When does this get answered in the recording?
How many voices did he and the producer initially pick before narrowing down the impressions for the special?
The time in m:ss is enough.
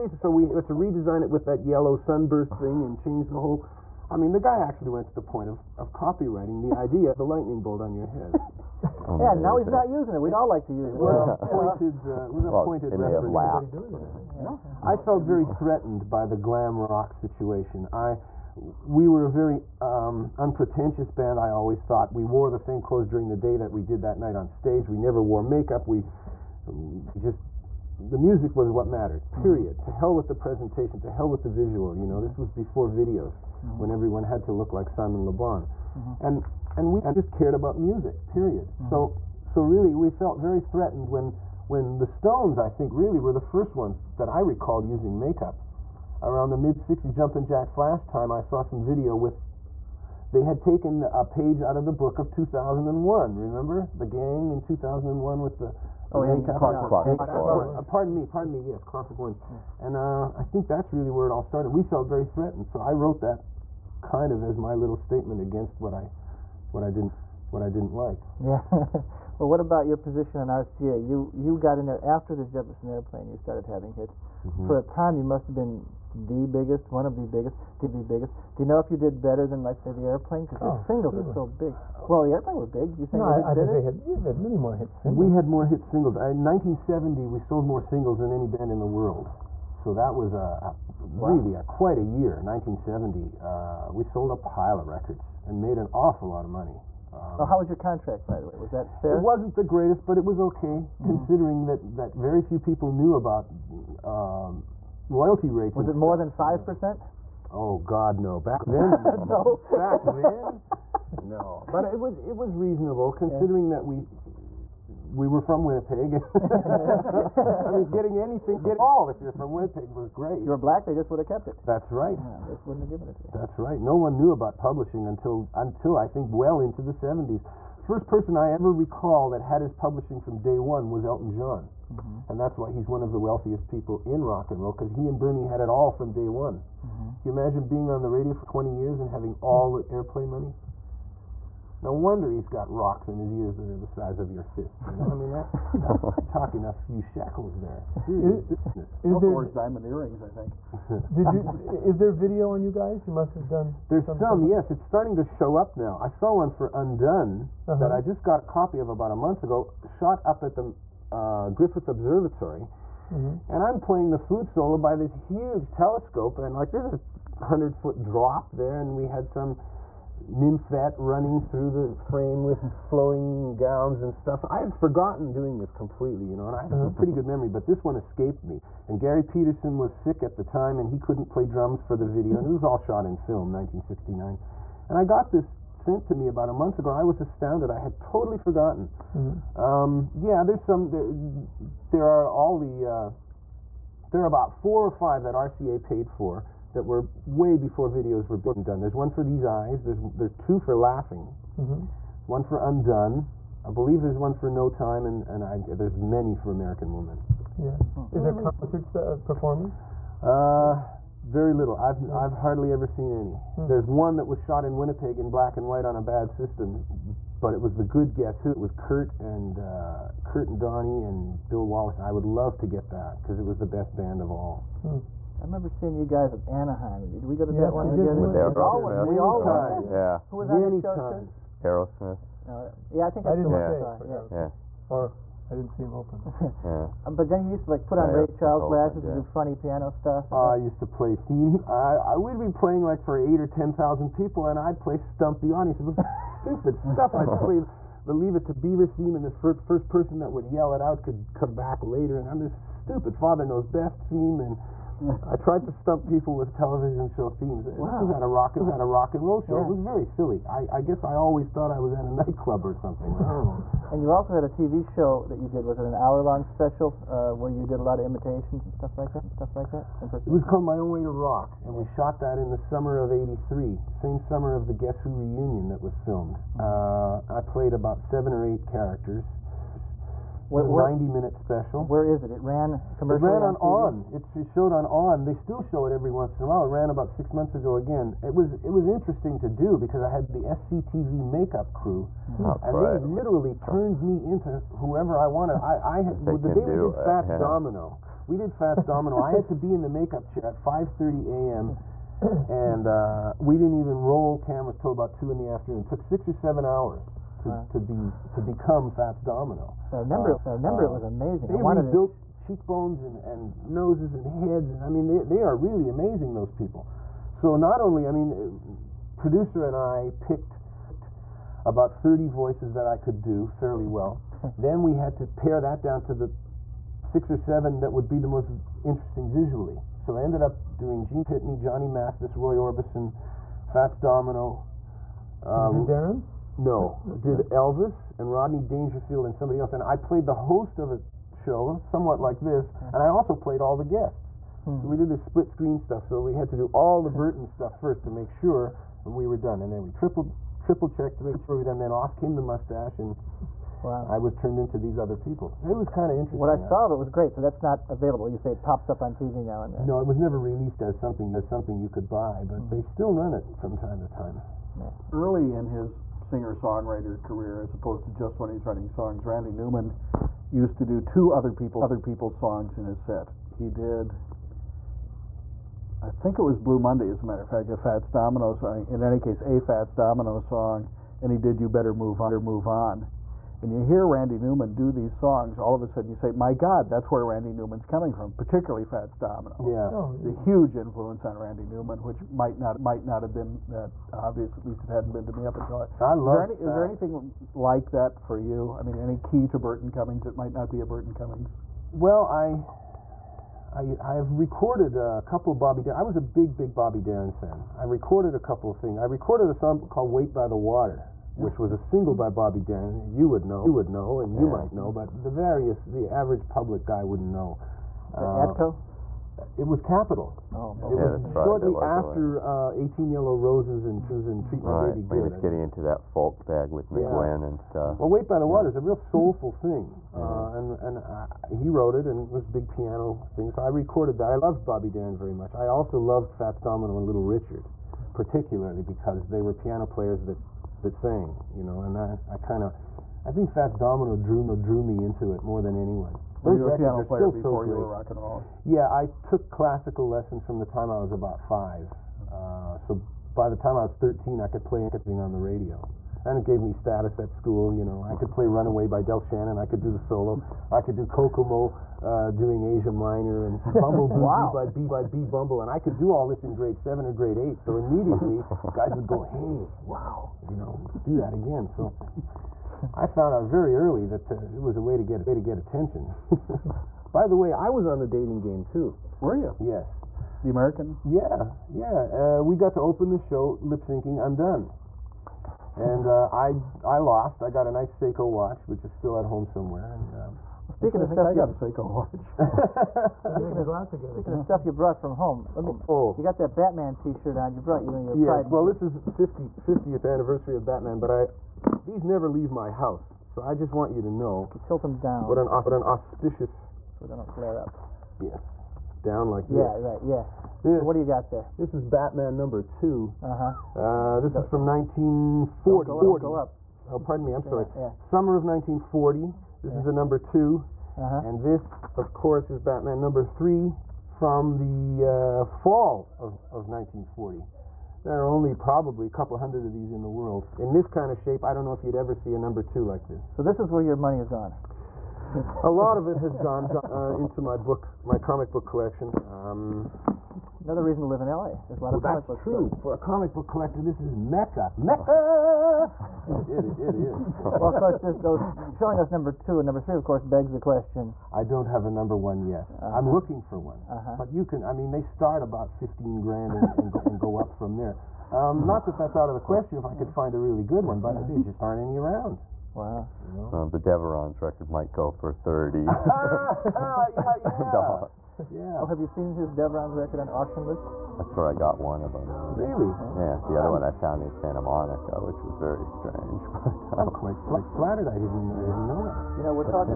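5:21.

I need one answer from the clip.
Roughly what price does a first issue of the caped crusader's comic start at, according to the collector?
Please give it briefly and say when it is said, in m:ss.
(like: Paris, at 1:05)
15 grand, at 9:15.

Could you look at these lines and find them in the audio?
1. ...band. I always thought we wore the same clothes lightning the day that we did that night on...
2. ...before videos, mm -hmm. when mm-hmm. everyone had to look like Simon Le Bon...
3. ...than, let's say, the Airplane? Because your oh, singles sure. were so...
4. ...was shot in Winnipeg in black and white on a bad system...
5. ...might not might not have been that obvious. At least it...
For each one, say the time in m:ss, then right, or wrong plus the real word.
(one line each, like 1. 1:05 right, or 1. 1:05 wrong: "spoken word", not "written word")
1. 0:21 wrong: "during", not "lightning"
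2. 0:32 right
3. 1:19 right
4. 3:34 right
5. 6:32 right.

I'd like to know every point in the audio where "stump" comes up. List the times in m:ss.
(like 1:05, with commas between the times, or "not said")
4:04, 4:15.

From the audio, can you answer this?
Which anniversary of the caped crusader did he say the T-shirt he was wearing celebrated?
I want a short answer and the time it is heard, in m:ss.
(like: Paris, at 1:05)
50th, at 8:19.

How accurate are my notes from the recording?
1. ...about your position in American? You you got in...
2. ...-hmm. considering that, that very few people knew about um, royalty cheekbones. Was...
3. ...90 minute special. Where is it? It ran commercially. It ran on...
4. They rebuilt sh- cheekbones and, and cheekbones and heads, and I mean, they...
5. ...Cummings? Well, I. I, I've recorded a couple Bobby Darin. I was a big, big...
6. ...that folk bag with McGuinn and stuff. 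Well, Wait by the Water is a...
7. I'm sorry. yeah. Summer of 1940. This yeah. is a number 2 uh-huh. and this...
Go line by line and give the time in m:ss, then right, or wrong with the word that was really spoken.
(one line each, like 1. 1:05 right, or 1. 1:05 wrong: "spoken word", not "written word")
1. 1:09 wrong: "RCA", not "American"
2. 1:40 wrong: "rates", not "cheekbones"
3. 4:40 right
4. 5:11 wrong: "noses", not "cheekbones"
5. 6:41 right
6. 7:05 right
7. 8:37 right.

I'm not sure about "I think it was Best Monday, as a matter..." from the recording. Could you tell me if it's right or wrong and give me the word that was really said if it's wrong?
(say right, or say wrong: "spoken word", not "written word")
wrong: "Blue", not "Best".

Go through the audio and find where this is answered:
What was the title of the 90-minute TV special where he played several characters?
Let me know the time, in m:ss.
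4:30.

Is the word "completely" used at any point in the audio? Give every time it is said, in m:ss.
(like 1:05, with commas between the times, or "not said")
2:55.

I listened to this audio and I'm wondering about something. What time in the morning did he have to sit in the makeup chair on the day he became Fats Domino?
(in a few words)
5:30 a.m.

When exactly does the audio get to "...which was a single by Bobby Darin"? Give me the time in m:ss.
6:51.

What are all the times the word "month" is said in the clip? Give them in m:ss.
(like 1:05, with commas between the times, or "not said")
2:39, 3:06, 4:47.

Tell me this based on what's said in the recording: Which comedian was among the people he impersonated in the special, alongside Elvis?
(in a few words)
Rodney Dangerfield.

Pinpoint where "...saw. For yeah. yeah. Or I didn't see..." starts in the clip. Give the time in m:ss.
3:53.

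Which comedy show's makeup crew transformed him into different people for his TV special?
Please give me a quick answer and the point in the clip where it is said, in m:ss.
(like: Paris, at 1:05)
SCTV, at 4:50.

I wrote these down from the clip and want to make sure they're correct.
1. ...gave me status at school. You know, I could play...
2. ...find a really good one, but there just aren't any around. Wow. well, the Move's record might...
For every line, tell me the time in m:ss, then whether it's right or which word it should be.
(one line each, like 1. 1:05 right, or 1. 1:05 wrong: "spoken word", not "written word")
1. 7:36 right
2. 9:20 wrong: "Deveron", not "Move".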